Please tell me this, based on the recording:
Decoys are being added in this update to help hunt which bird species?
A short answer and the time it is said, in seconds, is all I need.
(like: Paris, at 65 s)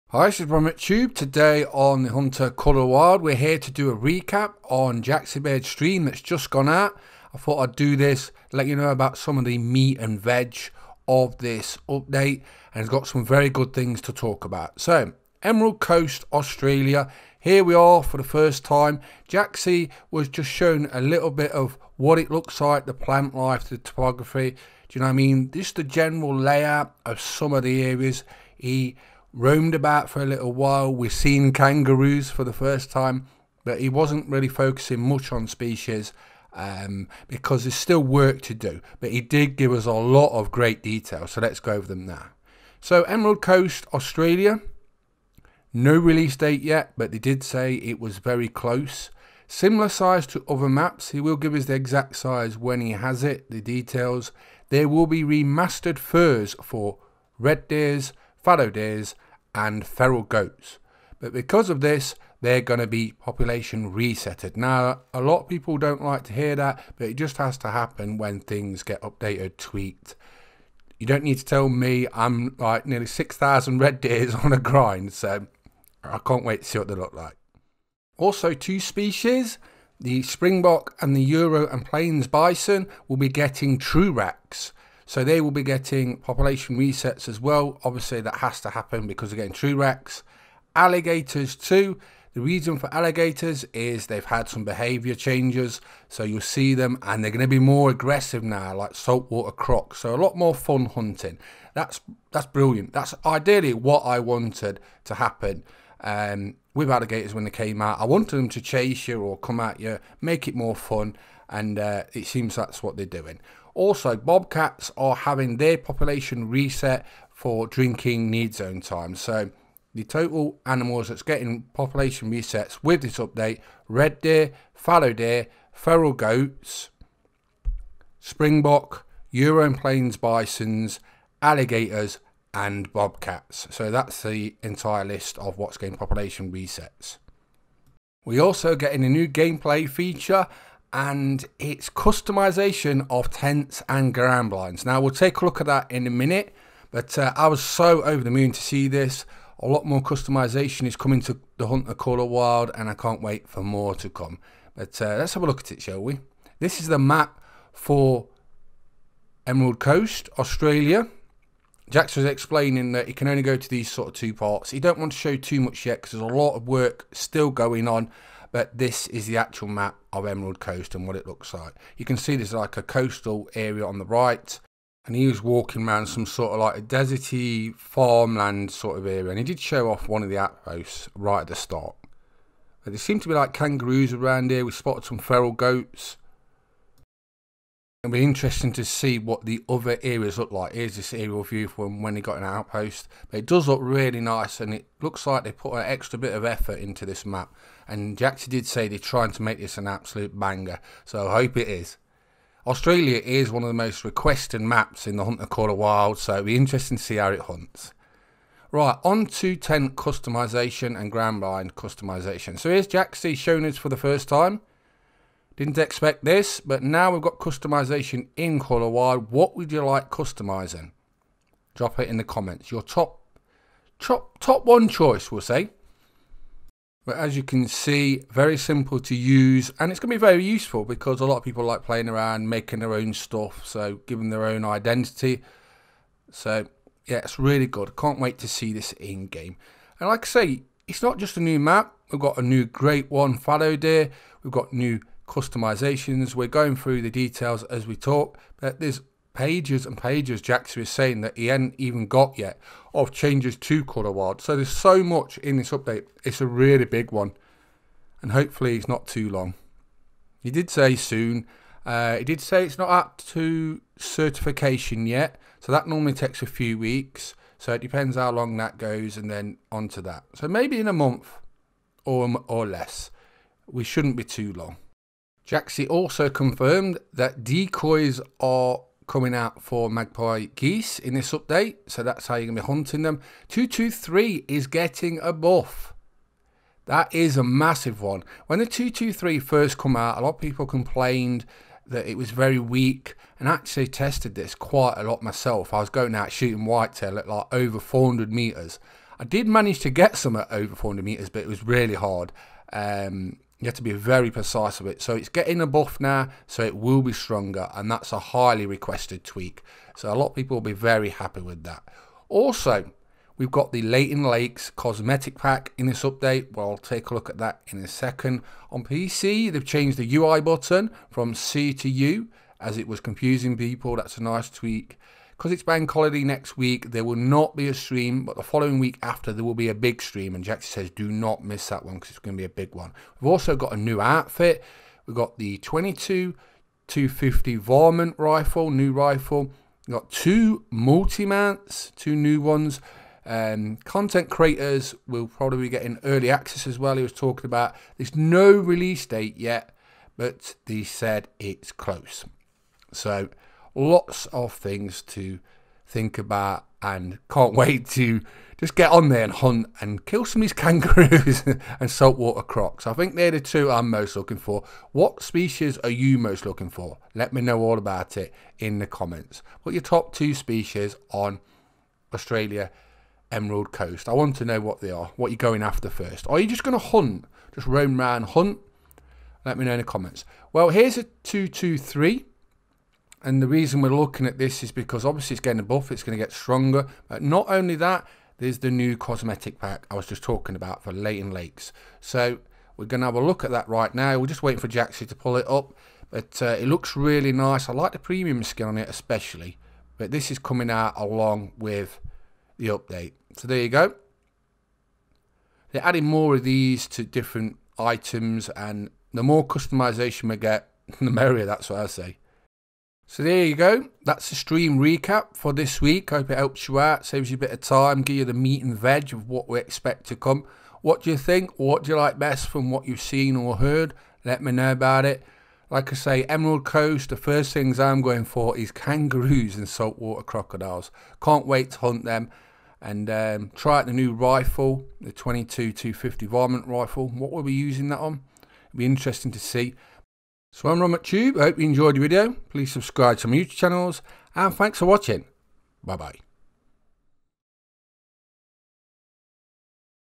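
magpie geese, at 279 s.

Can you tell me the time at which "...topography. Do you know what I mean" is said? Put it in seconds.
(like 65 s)
23 s.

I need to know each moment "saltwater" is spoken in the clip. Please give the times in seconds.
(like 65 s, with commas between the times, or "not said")
98 s, 361 s, 429 s.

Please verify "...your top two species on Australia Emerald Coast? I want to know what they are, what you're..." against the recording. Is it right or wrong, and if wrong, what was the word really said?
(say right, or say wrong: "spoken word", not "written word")
right.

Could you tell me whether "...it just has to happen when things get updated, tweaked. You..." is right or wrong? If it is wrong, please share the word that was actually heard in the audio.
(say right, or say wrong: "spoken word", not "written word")
right.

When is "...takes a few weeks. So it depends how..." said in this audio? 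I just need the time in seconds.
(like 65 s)
266 s.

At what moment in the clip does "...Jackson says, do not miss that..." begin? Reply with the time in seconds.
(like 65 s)
330 s.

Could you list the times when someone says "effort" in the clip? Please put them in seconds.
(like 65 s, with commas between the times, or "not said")
196 s.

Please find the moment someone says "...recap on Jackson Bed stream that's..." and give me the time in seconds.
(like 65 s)
3 s.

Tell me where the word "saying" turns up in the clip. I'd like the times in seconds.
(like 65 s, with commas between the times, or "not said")
250 s.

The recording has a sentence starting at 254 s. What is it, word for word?
So there's so much in this update.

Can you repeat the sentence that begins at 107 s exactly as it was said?
I wanted them to chase you or come at you, make it more fun and uh, it seems that's what they're doing.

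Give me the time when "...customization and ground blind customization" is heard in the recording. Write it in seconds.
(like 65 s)
209 s.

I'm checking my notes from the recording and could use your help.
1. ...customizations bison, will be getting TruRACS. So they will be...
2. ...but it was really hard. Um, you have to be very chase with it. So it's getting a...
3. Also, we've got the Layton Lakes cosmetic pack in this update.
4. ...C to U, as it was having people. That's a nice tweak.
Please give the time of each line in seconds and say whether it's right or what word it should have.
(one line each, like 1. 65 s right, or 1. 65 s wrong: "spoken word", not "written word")
1. 81 s wrong: "plains", not "customizations"
2. 301 s wrong: "precise", not "chase"
3. 312 s right
4. 321 s wrong: "confusing", not "having".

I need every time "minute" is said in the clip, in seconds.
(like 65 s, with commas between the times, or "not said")
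146 s.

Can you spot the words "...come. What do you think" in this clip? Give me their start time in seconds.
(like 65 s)
420 s.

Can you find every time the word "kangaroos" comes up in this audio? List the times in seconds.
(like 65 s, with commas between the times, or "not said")
31 s, 183 s, 360 s, 428 s.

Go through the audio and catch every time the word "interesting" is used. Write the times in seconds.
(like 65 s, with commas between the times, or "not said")
188 s, 206 s, 438 s.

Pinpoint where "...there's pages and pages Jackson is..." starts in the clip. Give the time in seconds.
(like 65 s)
248 s.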